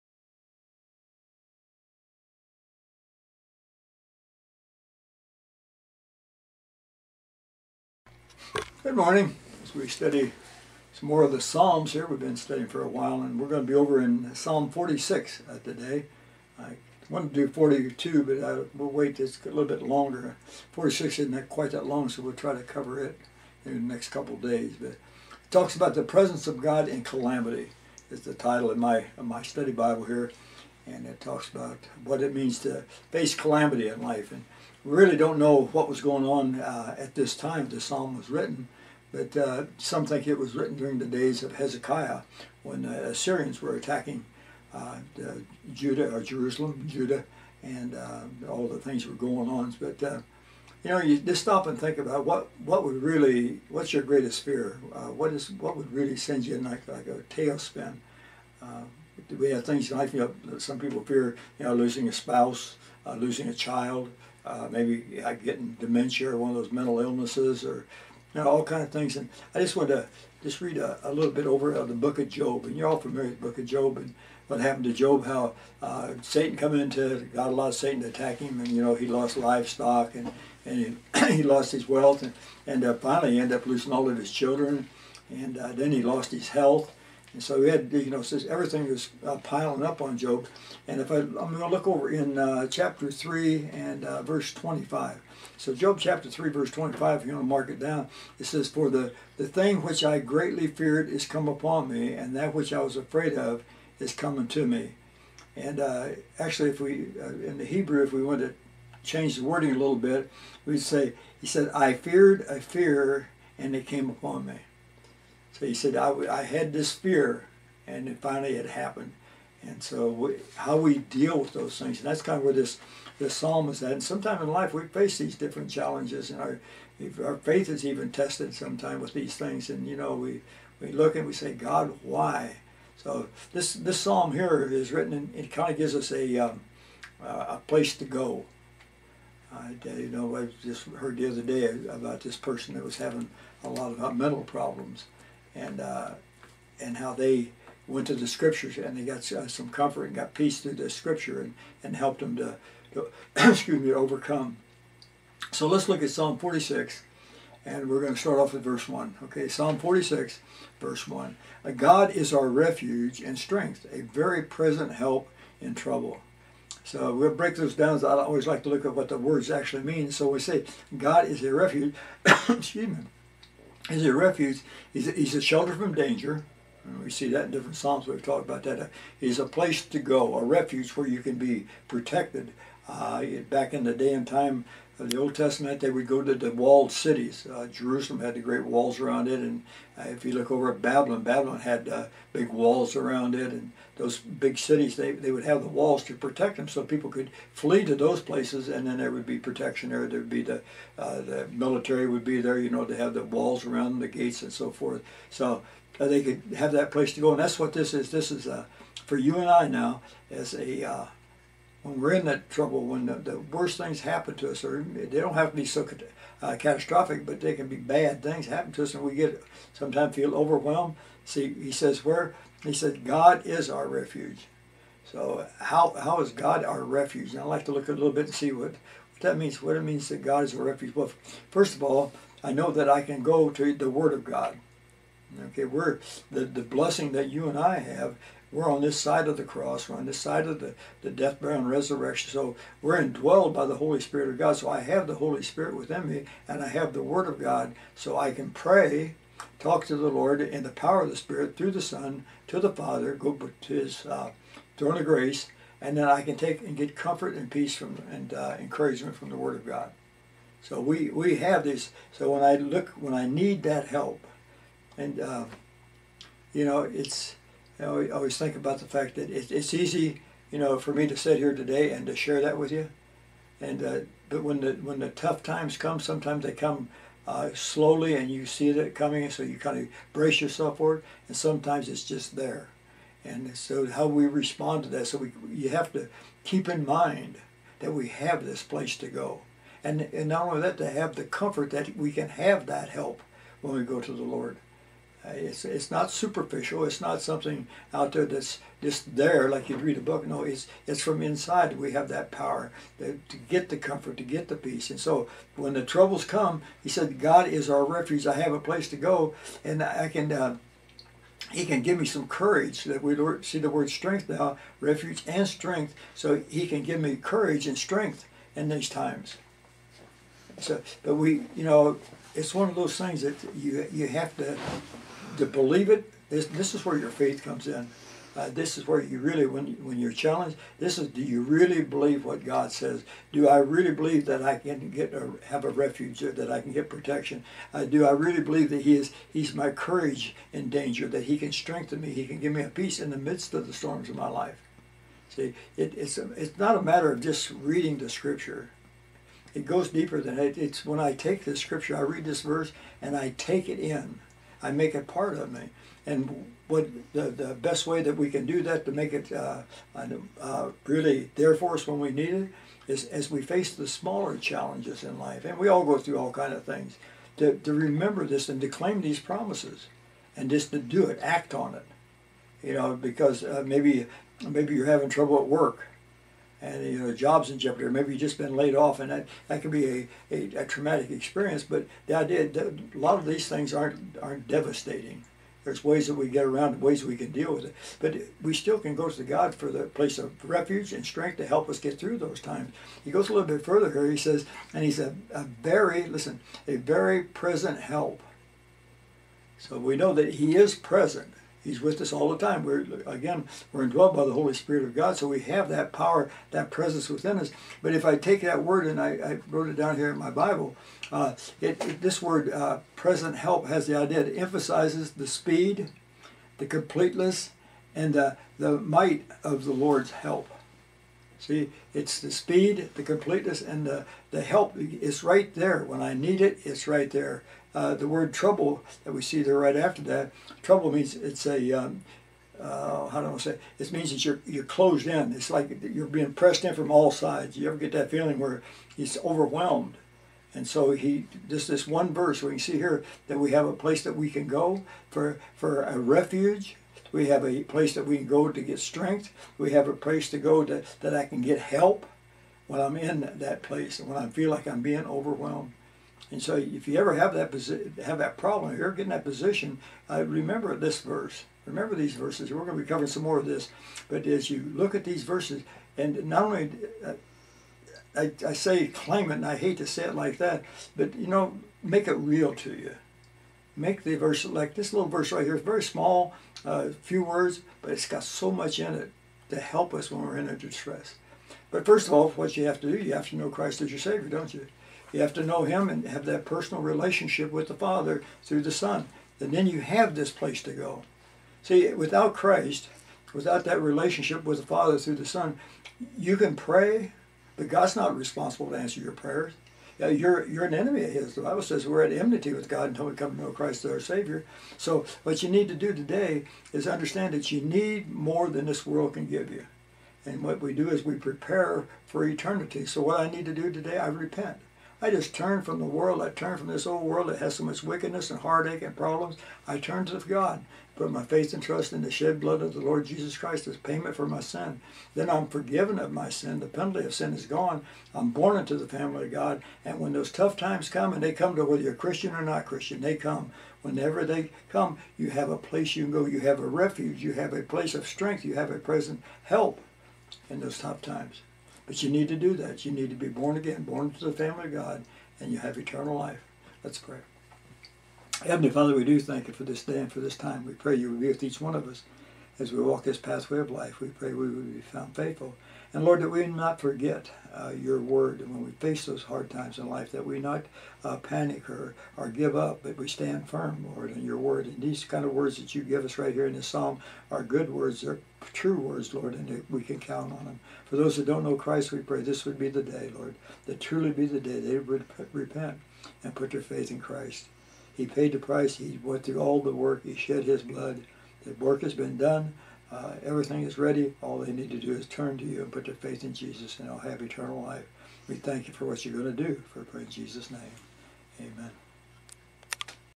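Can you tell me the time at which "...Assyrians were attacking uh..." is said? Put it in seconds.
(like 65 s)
43 s.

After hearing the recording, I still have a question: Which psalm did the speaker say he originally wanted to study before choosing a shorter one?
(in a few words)
Psalm 42.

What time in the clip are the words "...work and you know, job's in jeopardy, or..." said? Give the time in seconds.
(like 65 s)
375 s.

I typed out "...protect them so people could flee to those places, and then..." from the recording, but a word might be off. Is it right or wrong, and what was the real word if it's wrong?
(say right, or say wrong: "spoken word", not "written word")
right.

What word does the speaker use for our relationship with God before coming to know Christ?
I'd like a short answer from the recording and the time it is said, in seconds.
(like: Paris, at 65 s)
enmity, at 502 s.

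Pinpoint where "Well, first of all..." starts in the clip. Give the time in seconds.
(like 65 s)
230 s.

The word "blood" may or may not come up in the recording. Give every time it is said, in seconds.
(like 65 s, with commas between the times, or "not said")
522 s, 580 s.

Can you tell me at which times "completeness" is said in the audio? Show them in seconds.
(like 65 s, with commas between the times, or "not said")
416 s, 423 s.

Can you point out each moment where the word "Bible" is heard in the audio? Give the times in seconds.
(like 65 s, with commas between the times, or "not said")
29 s, 410 s, 501 s.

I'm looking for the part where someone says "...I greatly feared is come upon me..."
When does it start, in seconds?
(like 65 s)
100 s.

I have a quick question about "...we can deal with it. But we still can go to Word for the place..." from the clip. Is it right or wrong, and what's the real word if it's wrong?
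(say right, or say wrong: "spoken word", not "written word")
wrong: "God", not "Word".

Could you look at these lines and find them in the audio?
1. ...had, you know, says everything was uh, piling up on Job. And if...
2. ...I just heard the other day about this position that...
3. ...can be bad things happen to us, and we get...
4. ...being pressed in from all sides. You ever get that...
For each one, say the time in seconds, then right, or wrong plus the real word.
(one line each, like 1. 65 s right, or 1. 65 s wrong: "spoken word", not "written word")
1. 87 s right
2. 140 s wrong: "person", not "position"
3. 217 s right
4. 436 s right.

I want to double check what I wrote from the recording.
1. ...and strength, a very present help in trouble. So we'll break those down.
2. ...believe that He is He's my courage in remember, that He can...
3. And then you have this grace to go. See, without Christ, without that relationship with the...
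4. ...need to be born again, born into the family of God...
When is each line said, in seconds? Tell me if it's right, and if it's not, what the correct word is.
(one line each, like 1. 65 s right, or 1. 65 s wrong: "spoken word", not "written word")
1. 163 s right
2. 338 s wrong: "danger", not "remember"
3. 489 s wrong: "place", not "grace"
4. 542 s right.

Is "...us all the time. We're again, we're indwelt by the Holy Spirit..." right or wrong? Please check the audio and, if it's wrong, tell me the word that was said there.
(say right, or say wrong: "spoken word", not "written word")
right.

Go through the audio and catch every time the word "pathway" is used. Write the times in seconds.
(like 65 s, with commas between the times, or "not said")
553 s.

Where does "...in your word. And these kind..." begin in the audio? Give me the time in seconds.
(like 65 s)
564 s.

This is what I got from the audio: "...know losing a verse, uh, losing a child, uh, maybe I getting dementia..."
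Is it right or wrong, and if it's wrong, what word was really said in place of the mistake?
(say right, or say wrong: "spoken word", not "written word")
wrong: "spouse", not "verse".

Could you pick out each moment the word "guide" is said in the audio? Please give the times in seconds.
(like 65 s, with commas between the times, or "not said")
not said.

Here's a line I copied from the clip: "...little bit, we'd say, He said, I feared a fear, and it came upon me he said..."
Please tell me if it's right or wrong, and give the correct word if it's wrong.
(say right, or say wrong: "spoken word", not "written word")
right.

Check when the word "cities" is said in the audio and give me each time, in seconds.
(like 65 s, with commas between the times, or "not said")
186 s, 194 s.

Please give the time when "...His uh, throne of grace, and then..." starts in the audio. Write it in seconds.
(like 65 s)
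253 s.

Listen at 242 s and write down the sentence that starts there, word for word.
So we're indwelled by the Holy Spirit of God.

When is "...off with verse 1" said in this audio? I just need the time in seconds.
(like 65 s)
158 s.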